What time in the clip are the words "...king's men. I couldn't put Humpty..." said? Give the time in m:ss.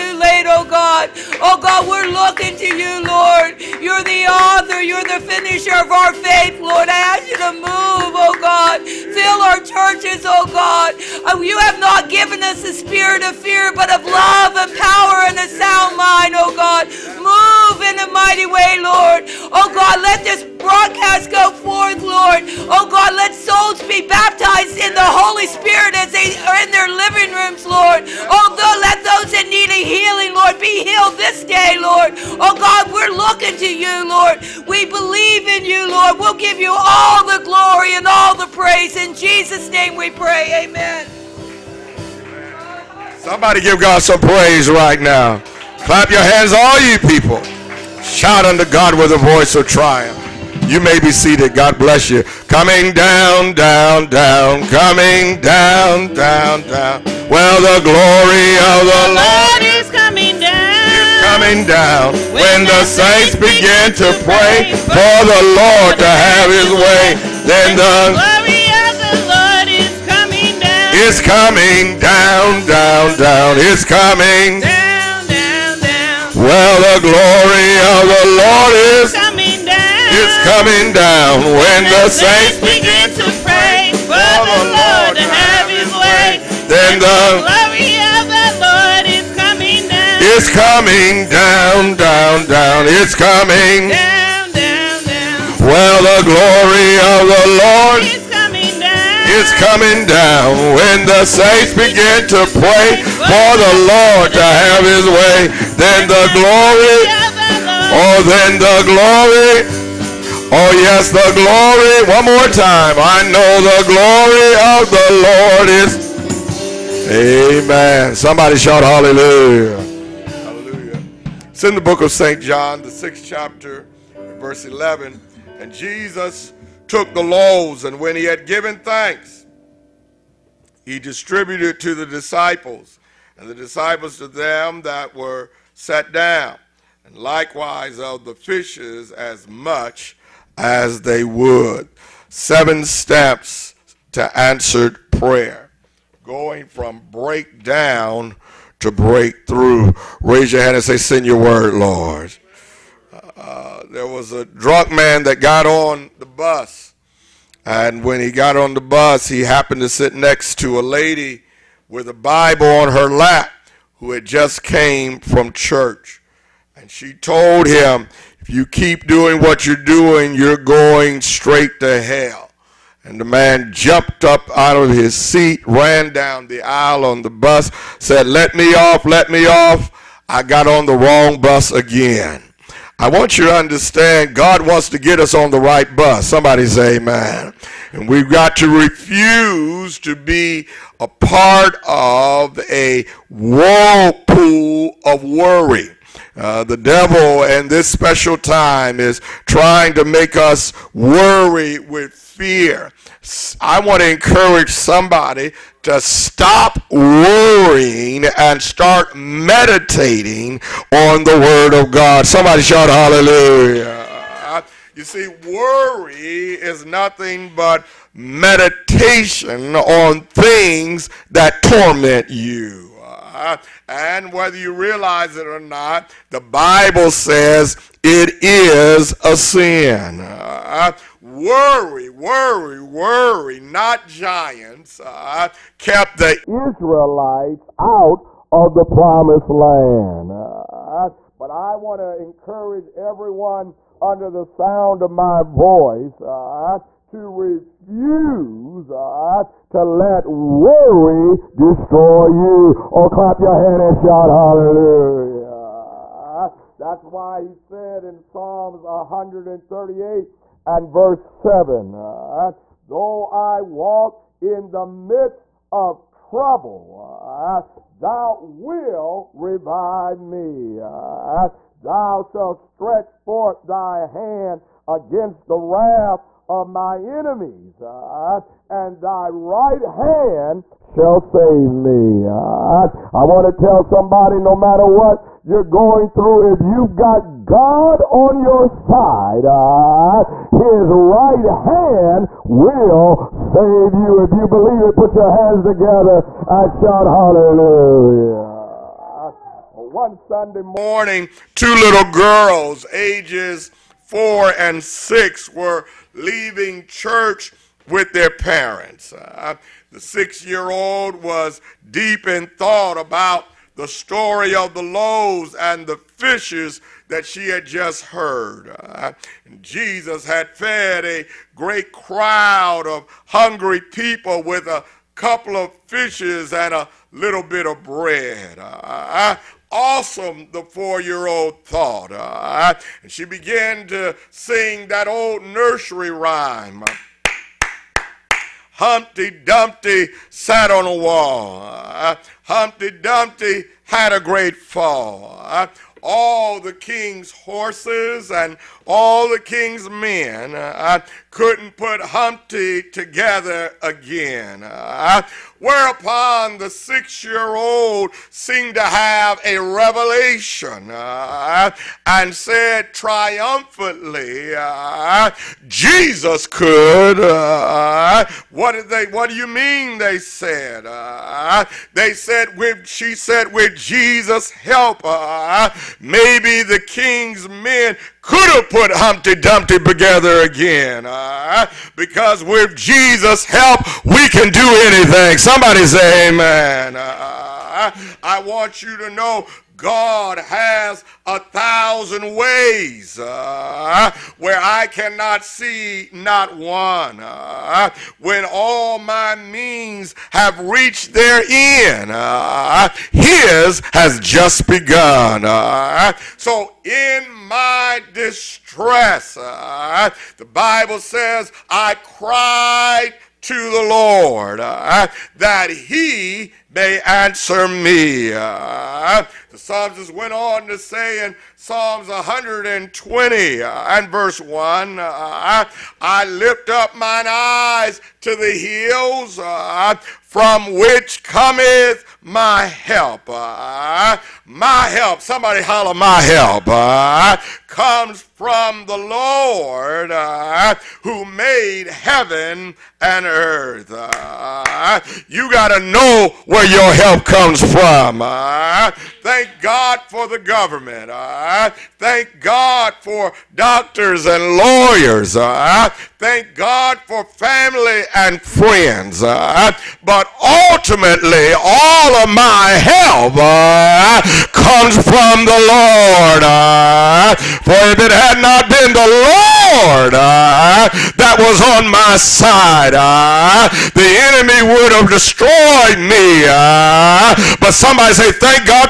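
5:49.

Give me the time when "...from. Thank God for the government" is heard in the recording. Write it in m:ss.
7:27.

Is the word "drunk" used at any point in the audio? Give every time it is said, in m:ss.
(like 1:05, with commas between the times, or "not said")
2:34.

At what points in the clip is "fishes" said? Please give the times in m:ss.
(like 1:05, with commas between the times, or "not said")
2:18, 5:15, 5:25.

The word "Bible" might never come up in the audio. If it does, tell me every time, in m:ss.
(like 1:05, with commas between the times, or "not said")
2:42, 3:46, 6:50.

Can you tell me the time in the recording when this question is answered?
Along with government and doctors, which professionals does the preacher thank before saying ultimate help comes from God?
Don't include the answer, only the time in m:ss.
7:34.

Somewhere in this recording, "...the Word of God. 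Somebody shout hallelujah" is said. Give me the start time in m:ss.
3:31.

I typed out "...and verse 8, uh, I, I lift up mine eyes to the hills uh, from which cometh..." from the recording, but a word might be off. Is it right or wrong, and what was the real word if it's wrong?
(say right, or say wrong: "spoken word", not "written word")
wrong: "1", not "8".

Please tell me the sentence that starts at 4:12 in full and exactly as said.
Or oh, clap your hand and shout hallelujah.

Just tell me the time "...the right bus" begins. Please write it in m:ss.
3:05.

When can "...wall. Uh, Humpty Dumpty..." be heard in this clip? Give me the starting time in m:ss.
5:40.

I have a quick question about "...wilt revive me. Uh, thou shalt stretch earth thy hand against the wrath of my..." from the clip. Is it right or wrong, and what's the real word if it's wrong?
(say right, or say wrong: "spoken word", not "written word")
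wrong: "forth", not "earth".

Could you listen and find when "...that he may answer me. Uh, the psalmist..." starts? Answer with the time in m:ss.
6:55.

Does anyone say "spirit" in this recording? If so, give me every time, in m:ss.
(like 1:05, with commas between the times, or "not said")
0:12, 0:25.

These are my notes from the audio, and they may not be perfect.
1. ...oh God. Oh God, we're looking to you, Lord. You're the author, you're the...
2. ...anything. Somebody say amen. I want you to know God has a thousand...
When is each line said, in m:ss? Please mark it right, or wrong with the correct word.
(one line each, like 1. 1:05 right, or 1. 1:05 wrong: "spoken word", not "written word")
1. 0:00 right
2. 6:24 right.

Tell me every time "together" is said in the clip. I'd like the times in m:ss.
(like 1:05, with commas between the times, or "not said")
4:55, 5:52, 6:19.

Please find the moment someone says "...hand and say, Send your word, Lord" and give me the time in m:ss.
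2:30.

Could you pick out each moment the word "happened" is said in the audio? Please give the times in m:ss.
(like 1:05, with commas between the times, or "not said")
2:39.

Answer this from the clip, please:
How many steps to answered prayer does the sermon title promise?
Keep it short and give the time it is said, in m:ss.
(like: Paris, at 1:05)
7, at 2:22.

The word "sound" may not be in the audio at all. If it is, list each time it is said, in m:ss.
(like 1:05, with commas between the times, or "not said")
0:15, 4:04.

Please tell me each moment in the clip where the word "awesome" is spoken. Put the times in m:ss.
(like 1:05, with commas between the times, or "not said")
5:29.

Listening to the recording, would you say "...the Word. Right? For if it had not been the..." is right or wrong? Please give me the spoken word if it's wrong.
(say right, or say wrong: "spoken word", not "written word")
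wrong: "Lord", not "Word".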